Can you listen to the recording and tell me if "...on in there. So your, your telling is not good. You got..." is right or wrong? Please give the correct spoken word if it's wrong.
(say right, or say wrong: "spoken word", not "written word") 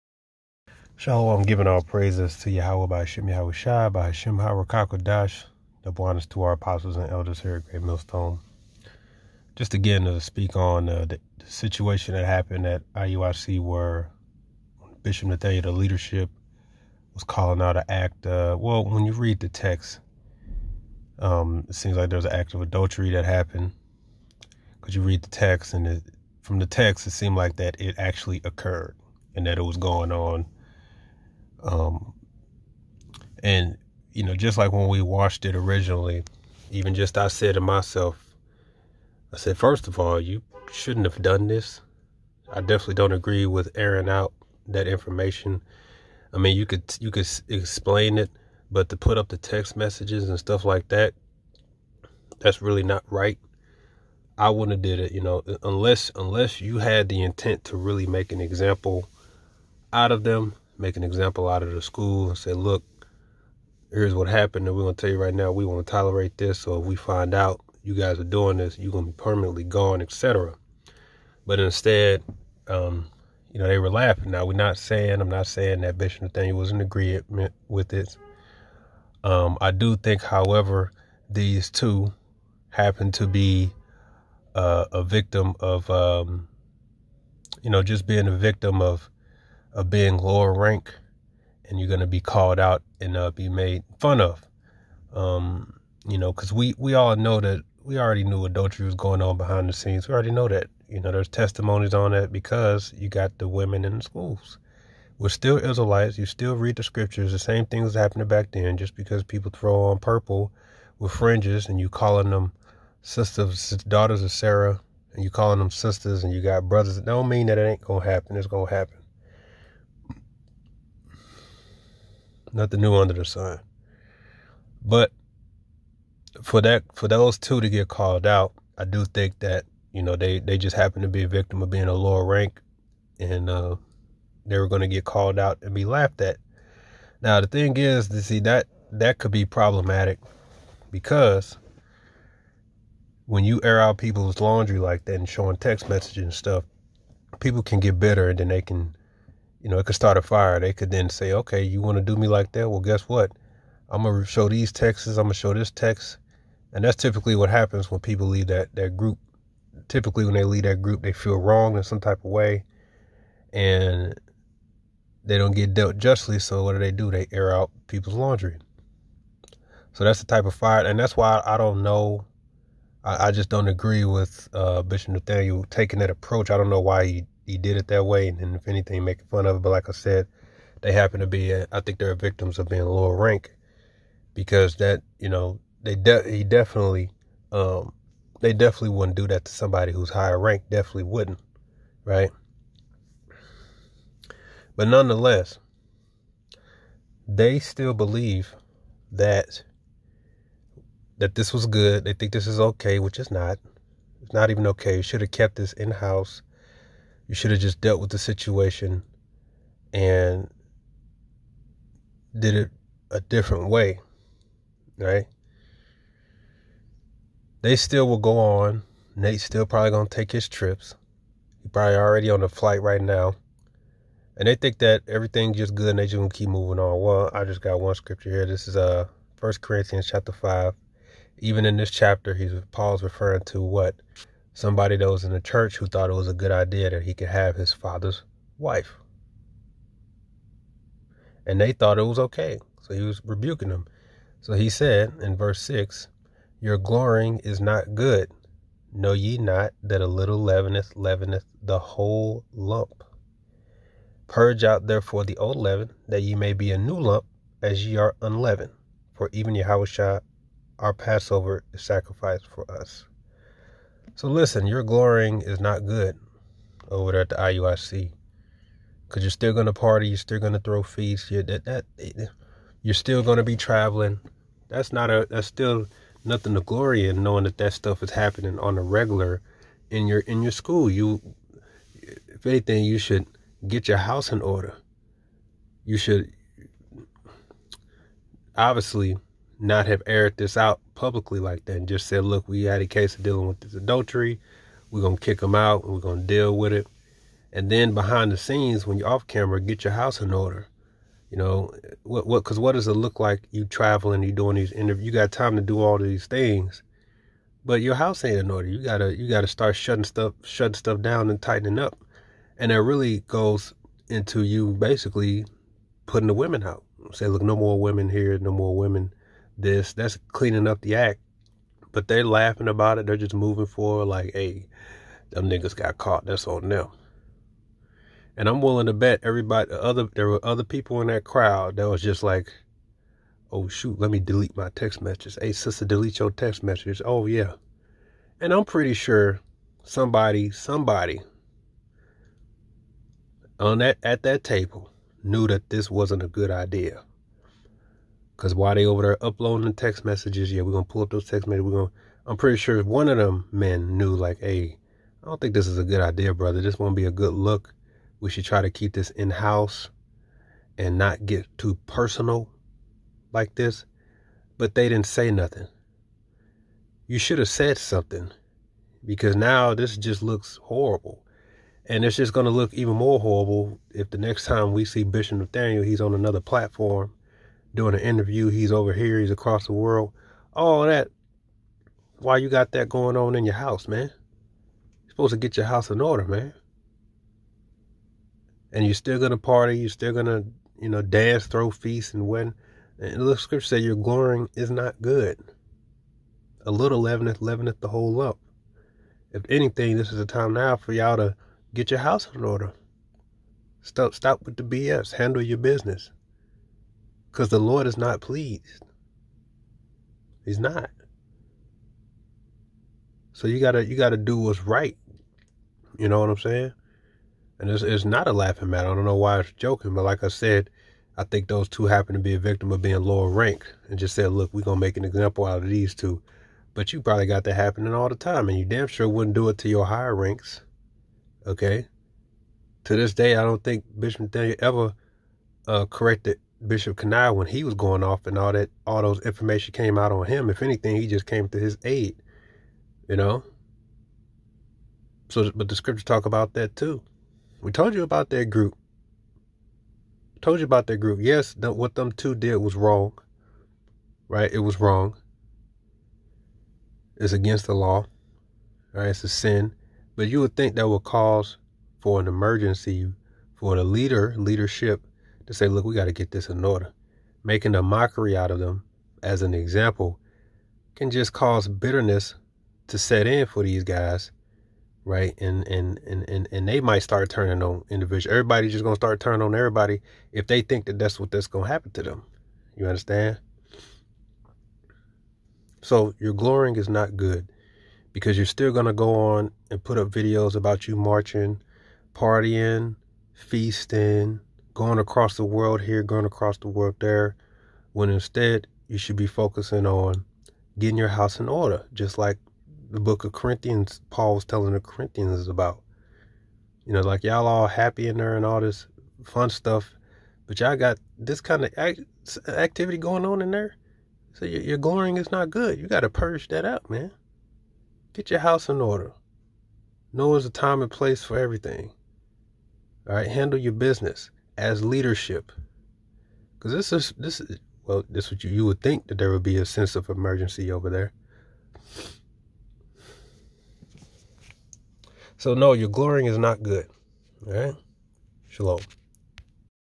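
wrong: "glorying", not "telling".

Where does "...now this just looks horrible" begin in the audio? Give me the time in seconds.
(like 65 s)
369 s.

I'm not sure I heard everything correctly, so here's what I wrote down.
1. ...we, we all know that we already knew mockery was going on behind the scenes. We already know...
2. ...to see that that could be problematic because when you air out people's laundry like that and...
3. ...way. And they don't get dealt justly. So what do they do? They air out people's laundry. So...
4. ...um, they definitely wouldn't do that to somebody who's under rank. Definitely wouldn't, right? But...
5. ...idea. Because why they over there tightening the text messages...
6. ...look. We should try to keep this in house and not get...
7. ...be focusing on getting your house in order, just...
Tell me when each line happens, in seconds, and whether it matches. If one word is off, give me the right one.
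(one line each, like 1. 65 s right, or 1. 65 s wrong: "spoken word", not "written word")
1. 96 s wrong: "adultery", not "mockery"
2. 138 s right
3. 162 s right
4. 187 s wrong: "higher", not "under"
5. 346 s wrong: "uploading", not "tightening"
6. 357 s right
7. 499 s right.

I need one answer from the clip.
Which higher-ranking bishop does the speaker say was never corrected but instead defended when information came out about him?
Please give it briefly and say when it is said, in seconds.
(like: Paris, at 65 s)
Bishop Kanai, at 436 s.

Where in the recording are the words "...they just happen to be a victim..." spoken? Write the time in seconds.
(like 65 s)
130 s.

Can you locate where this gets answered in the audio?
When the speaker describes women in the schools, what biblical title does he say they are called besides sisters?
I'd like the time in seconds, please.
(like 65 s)
113 s.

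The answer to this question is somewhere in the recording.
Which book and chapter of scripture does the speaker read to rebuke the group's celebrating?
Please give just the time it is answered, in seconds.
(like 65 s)
229 s.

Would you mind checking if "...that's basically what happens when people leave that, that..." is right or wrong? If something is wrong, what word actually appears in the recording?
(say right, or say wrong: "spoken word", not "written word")
wrong: "typically", not "basically".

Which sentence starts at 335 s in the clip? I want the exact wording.
Hey sister, delete your text messages.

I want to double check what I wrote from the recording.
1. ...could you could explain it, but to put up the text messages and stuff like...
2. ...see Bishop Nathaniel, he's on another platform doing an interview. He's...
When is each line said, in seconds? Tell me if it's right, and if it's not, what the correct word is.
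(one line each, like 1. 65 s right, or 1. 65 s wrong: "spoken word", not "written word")
1. 46 s right
2. 374 s right.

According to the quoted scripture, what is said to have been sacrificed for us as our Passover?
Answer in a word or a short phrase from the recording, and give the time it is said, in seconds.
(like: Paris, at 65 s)
Yahushua, at 259 s.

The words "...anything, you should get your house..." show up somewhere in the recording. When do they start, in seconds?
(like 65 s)
282 s.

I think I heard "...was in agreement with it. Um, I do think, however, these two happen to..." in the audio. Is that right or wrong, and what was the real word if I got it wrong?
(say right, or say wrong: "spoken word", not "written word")
right.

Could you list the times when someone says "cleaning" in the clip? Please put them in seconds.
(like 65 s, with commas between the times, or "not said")
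320 s.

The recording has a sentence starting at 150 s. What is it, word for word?
They could then say, okay, you want to do me like that?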